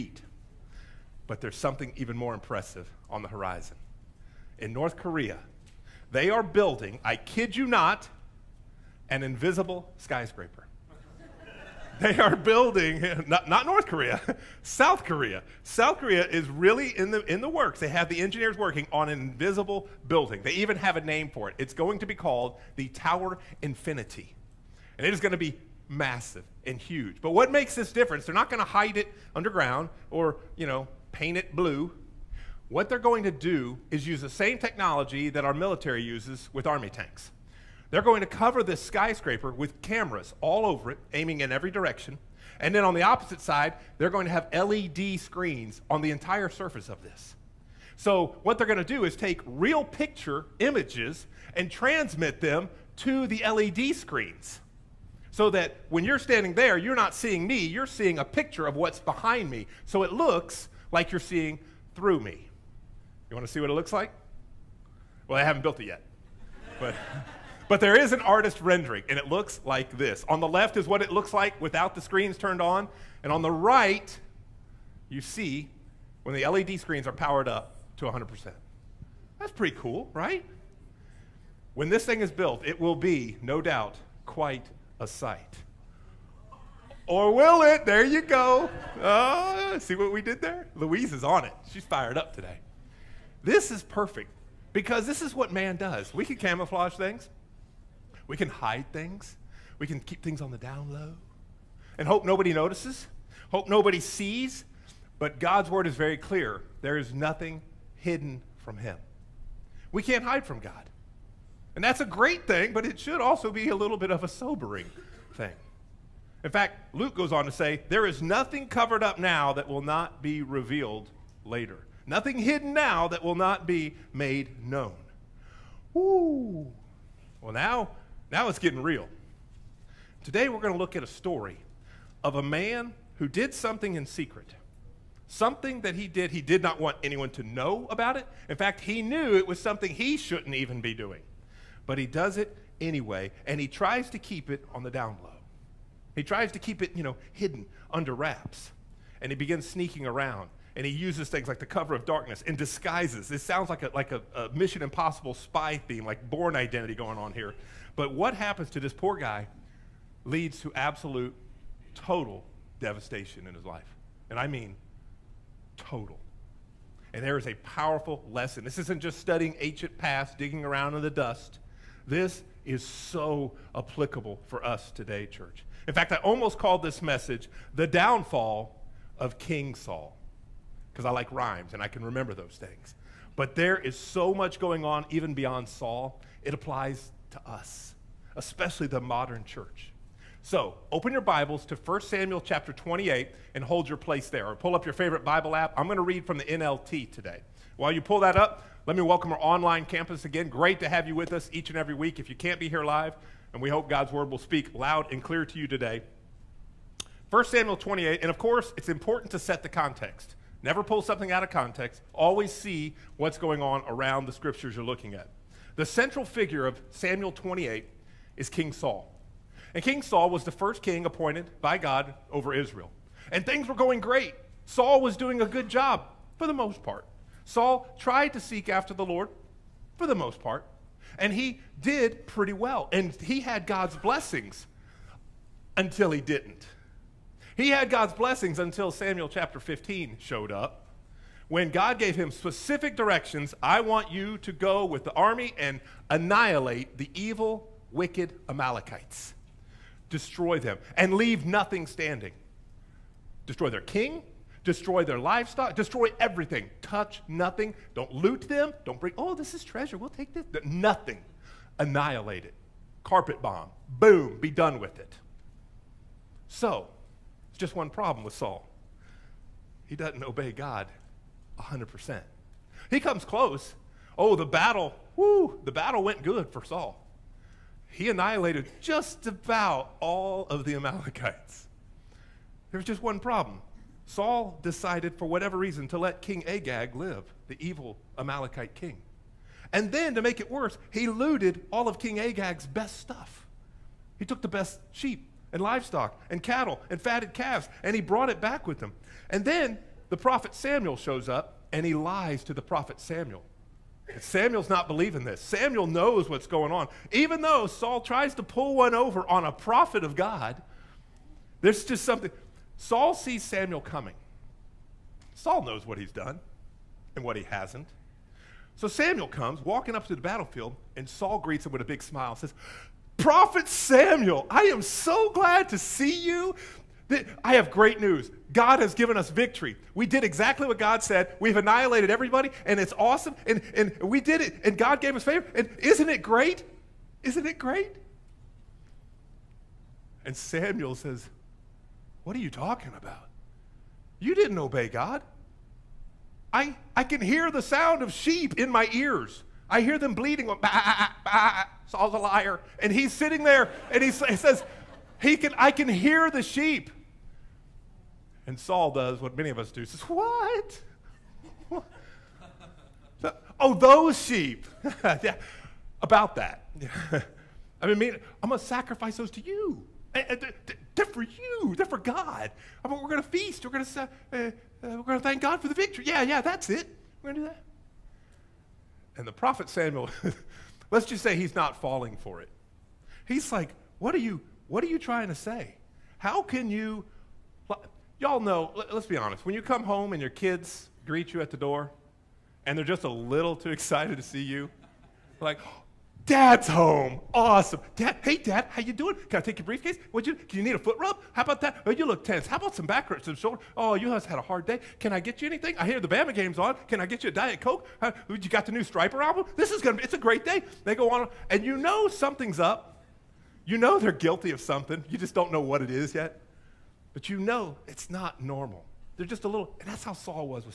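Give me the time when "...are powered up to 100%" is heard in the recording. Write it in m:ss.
1:17.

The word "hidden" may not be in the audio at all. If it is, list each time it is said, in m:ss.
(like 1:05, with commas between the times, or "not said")
1:47, 2:02, 2:27.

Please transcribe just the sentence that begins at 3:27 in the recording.
1 Samuel 28, and of course, it's important to set the context.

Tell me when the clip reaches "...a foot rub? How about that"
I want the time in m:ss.
6:40.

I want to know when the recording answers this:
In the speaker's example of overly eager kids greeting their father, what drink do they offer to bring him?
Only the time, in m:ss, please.
6:47.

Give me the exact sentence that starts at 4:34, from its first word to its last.
Oh, the battle, whoo, the battle went good for Saul.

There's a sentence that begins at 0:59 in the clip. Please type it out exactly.
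So it looks like you're seeing through me.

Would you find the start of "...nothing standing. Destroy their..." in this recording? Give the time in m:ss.
4:11.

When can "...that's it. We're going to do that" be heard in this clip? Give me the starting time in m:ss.
6:16.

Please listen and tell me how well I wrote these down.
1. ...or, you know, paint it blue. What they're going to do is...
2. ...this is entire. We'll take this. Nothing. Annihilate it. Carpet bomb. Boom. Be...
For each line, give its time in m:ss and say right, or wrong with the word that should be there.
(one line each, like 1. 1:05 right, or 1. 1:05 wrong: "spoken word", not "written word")
1. 0:30 right
2. 4:19 wrong: "treasure", not "entire".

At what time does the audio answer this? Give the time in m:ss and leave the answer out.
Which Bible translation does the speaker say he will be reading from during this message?
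3:16.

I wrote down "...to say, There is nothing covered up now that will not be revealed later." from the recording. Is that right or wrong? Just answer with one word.
right.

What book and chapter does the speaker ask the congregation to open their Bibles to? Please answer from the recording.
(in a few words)
1 Samuel 28.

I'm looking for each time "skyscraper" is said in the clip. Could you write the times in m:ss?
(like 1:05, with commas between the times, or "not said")
0:09, 0:38.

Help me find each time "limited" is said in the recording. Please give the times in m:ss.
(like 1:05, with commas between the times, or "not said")
not said.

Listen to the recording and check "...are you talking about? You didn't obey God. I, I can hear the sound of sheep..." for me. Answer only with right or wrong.
right.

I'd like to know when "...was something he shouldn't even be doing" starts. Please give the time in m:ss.
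2:19.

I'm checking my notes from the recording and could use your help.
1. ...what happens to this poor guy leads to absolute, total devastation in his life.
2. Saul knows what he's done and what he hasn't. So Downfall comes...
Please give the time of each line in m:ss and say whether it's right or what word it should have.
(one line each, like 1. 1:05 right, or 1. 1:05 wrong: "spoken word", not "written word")
1. 2:38 right
2. 5:15 wrong: "Samuel", not "Downfall".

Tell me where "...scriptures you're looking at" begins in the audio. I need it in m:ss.
3:34.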